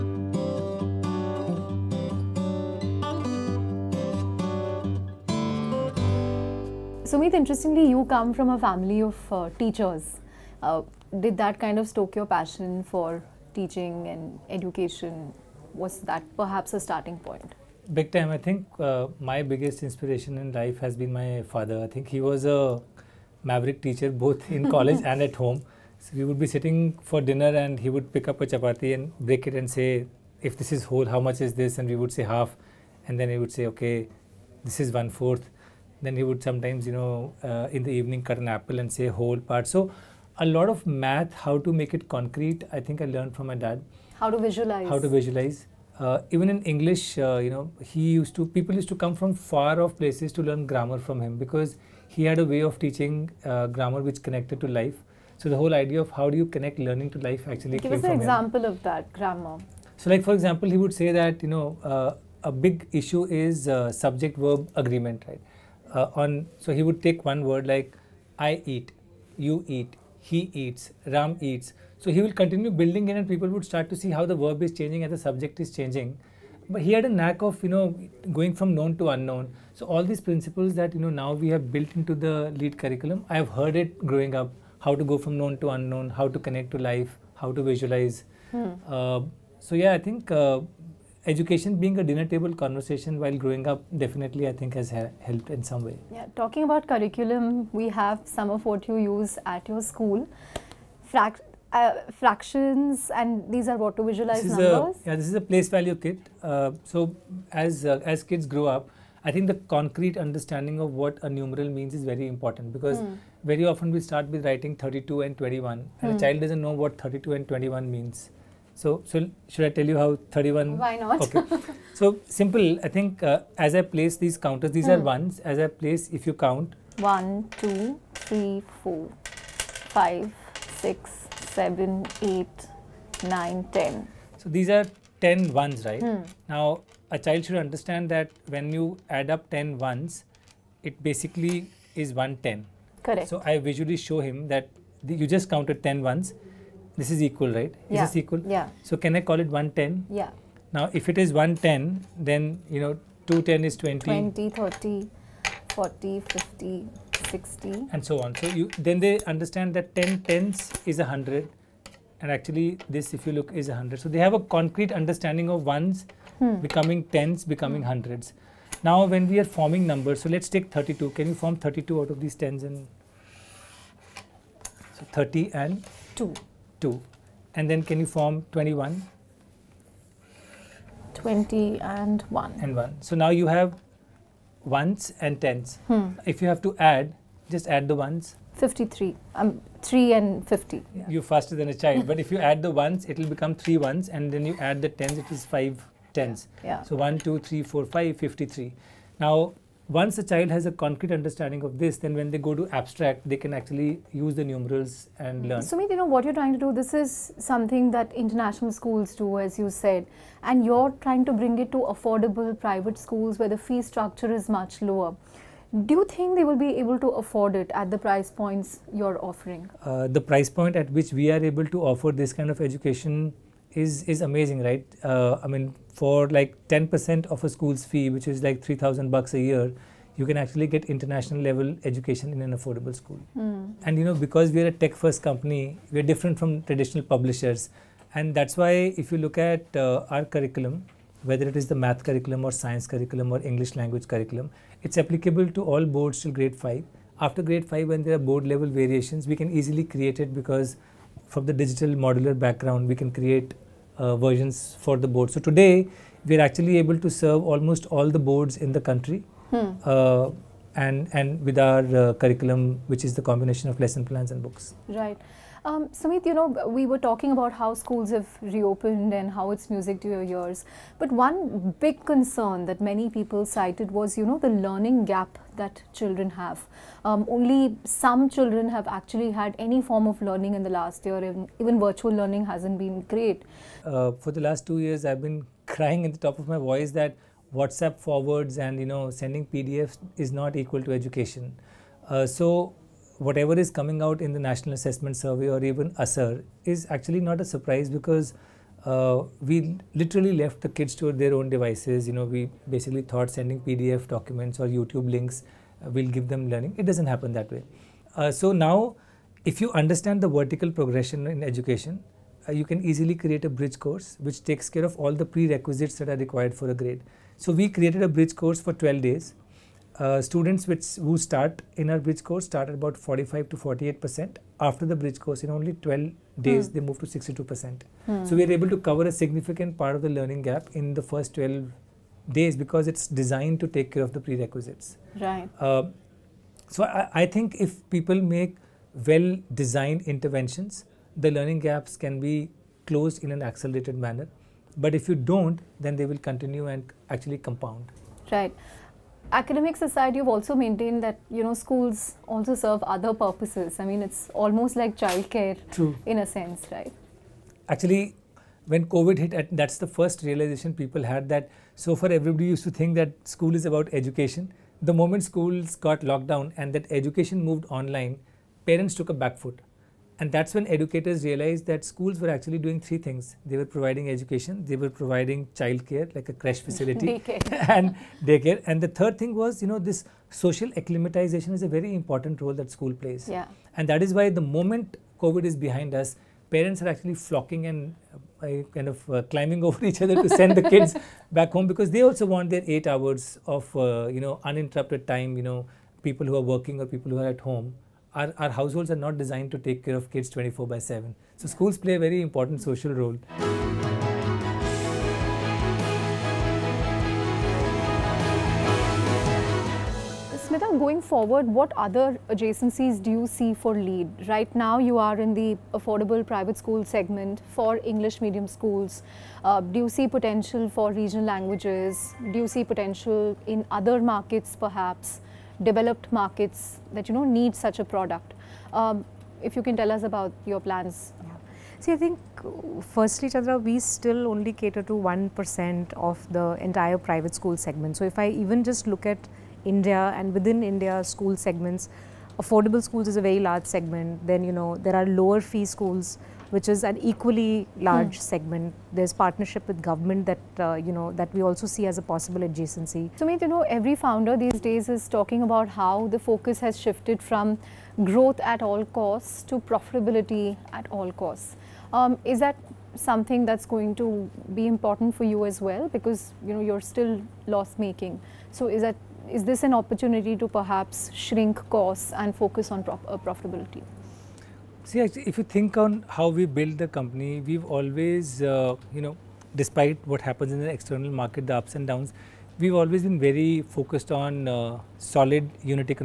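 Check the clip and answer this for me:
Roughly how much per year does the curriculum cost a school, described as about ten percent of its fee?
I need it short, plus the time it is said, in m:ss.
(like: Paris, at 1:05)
3,000, at 3:48.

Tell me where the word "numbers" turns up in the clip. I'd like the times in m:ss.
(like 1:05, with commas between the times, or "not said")
1:44, 2:49.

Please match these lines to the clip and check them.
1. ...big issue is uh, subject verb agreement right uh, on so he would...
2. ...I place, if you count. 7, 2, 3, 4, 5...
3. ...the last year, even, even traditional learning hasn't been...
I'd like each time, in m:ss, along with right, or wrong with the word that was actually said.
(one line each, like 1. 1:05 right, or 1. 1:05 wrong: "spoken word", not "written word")
1. 1:02 right
2. 2:05 wrong: "1", not "7"
3. 4:40 wrong: "virtual", not "traditional".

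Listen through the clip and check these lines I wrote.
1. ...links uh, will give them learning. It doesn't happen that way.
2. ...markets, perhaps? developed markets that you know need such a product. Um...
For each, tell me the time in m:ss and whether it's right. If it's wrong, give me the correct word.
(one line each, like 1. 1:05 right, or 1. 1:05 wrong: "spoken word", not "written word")
1. 5:05 right
2. 7:04 right.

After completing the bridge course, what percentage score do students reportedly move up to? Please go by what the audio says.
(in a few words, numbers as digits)
62 percent.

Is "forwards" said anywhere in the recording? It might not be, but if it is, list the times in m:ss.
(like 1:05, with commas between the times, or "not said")
4:47, 6:51.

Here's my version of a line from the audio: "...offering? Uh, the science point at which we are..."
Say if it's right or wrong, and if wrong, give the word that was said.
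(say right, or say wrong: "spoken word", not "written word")
wrong: "price", not "science".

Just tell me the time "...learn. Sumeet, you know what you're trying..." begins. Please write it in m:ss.
3:25.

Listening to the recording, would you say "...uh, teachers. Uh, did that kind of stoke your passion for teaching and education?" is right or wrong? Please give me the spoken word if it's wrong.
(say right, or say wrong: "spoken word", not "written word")
right.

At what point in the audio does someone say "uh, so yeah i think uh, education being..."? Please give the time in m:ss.
1:28.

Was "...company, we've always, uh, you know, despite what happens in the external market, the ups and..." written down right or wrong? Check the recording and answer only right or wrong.
right.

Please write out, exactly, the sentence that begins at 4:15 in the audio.
So today, we are actually able to serve almost all the boards in the country.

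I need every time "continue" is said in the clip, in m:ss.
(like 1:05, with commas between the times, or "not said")
1:12, 5:46.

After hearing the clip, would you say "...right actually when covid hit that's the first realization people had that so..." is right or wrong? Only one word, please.
right.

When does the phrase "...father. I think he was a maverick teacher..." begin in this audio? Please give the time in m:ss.
0:21.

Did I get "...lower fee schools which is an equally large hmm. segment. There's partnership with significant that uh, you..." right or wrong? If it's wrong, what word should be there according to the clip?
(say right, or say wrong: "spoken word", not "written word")
wrong: "government", not "significant".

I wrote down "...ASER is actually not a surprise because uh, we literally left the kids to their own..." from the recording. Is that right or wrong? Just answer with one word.
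right.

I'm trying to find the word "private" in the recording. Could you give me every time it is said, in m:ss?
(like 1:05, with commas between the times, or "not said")
3:32, 6:56, 7:16.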